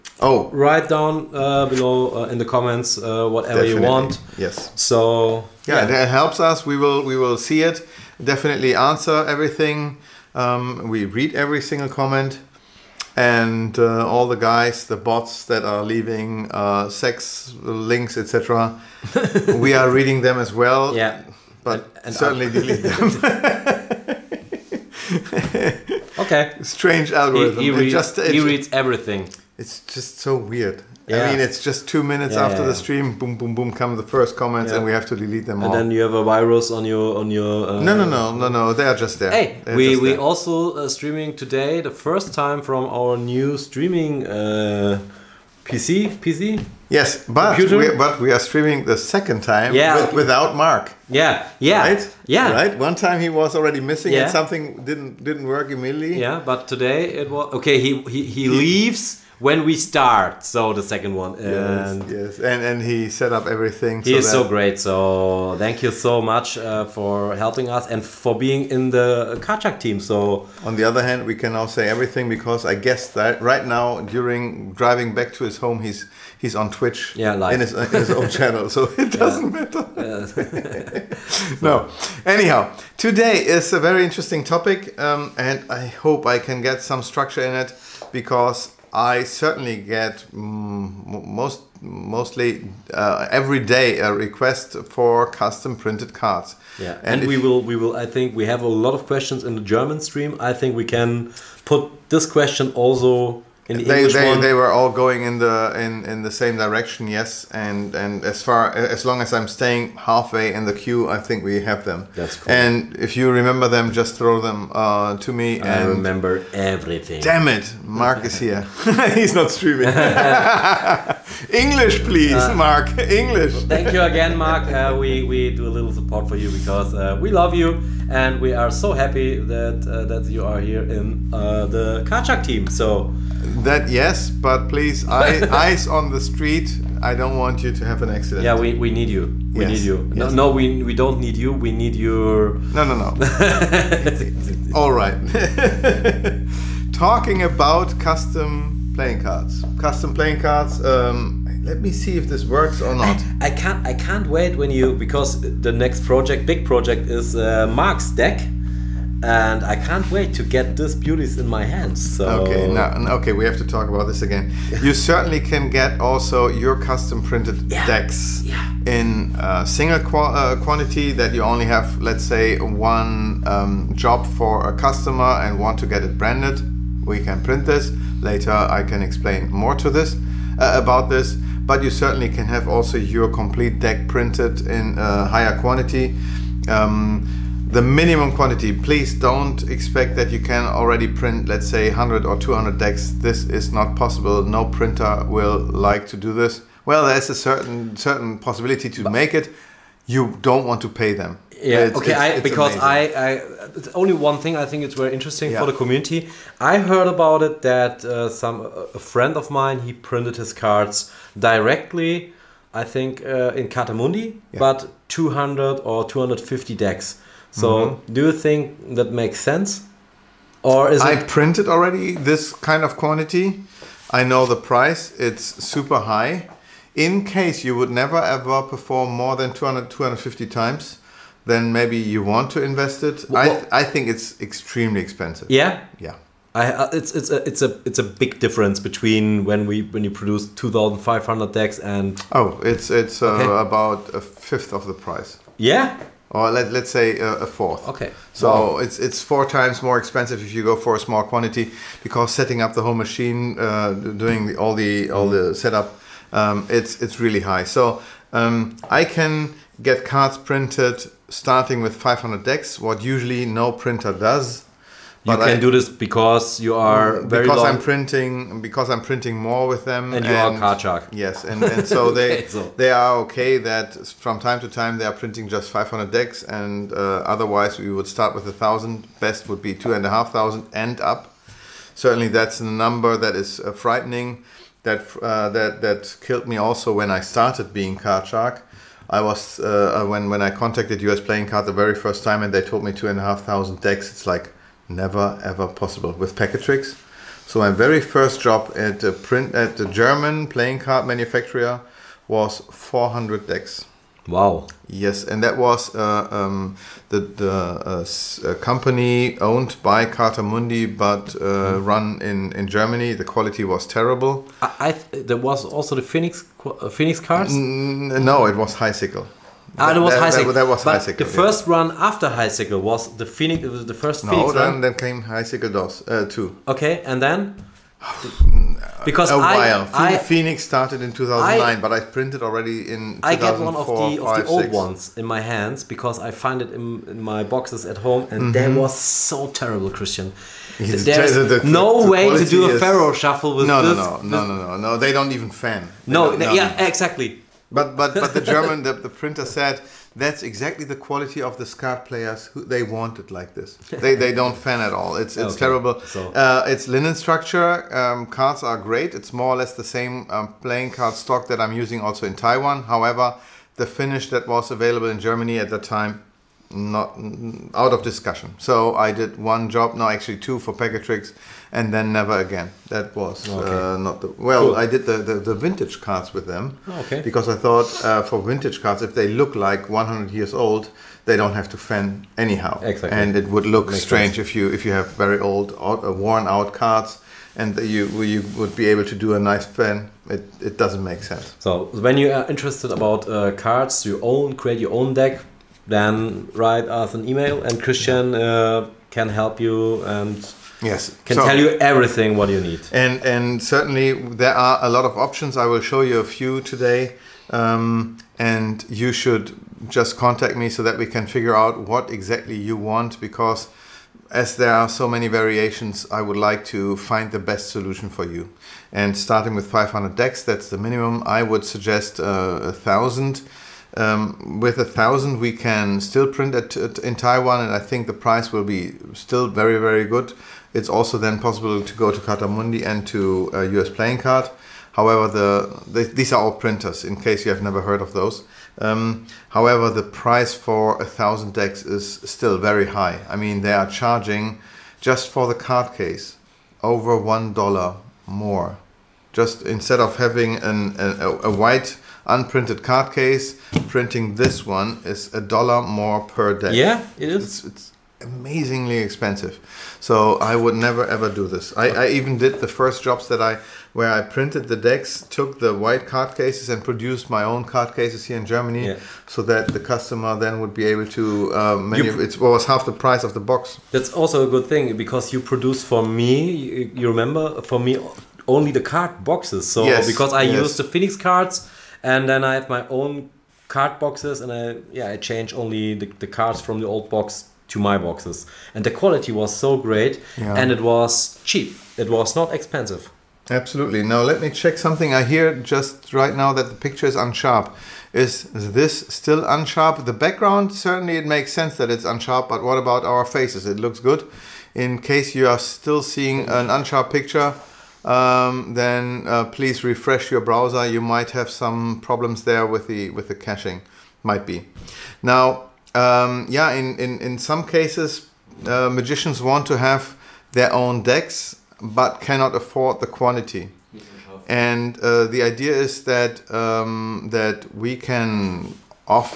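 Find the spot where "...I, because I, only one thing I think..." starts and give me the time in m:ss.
3:22.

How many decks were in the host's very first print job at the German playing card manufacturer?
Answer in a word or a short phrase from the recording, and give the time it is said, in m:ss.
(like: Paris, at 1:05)
400, at 5:02.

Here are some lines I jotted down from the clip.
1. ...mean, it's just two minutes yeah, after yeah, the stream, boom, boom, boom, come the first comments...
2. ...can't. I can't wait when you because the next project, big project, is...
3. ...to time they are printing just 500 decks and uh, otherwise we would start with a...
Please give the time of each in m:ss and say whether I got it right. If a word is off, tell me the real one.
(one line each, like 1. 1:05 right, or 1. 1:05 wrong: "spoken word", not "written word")
1. 0:31 right
2. 2:33 right
3. 4:34 right.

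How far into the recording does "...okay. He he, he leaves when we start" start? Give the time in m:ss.
0:57.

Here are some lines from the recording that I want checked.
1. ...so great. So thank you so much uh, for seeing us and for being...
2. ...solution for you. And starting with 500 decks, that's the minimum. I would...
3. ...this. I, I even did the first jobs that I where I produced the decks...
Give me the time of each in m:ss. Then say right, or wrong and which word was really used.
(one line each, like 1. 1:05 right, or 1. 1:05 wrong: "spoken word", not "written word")
1. 1:04 wrong: "helping", not "seeing"
2. 6:57 right
3. 7:41 wrong: "printed", not "produced".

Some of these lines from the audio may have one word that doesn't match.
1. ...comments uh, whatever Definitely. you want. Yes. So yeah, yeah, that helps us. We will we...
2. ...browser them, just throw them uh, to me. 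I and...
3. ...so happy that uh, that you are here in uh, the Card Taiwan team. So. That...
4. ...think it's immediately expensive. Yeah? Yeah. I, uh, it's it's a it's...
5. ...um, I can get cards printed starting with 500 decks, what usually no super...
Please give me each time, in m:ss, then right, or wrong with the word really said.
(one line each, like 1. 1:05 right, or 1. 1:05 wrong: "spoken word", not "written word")
1. 0:02 right
2. 1:53 wrong: "remember", not "browser"
3. 2:08 wrong: "Shark", not "Taiwan"
4. 3:53 wrong: "extremely", not "immediately"
5. 4:18 wrong: "printer", not "super".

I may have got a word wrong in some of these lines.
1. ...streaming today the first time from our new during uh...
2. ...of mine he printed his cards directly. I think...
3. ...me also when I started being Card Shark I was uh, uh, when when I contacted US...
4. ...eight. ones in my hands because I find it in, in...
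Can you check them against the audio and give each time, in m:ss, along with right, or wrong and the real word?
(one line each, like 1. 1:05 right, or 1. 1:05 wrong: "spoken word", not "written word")
1. 0:40 wrong: "streaming", not "during"
2. 3:29 right
3. 4:46 right
4. 5:34 wrong: "six", not "eight".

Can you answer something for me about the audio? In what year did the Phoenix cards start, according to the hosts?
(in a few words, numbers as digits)
2009.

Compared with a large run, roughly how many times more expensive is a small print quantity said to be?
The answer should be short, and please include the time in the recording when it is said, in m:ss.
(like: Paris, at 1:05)
4, at 4:09.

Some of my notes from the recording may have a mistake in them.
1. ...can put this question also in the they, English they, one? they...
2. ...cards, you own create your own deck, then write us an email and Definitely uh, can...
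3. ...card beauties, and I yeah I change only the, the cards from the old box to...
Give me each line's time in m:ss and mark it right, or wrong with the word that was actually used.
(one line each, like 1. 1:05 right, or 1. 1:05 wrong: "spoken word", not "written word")
1. 1:40 right
2. 6:33 wrong: "Christian", not "Definitely"
3. 8:03 wrong: "boxes", not "beauties".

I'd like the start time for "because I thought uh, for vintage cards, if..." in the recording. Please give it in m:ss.
6:17.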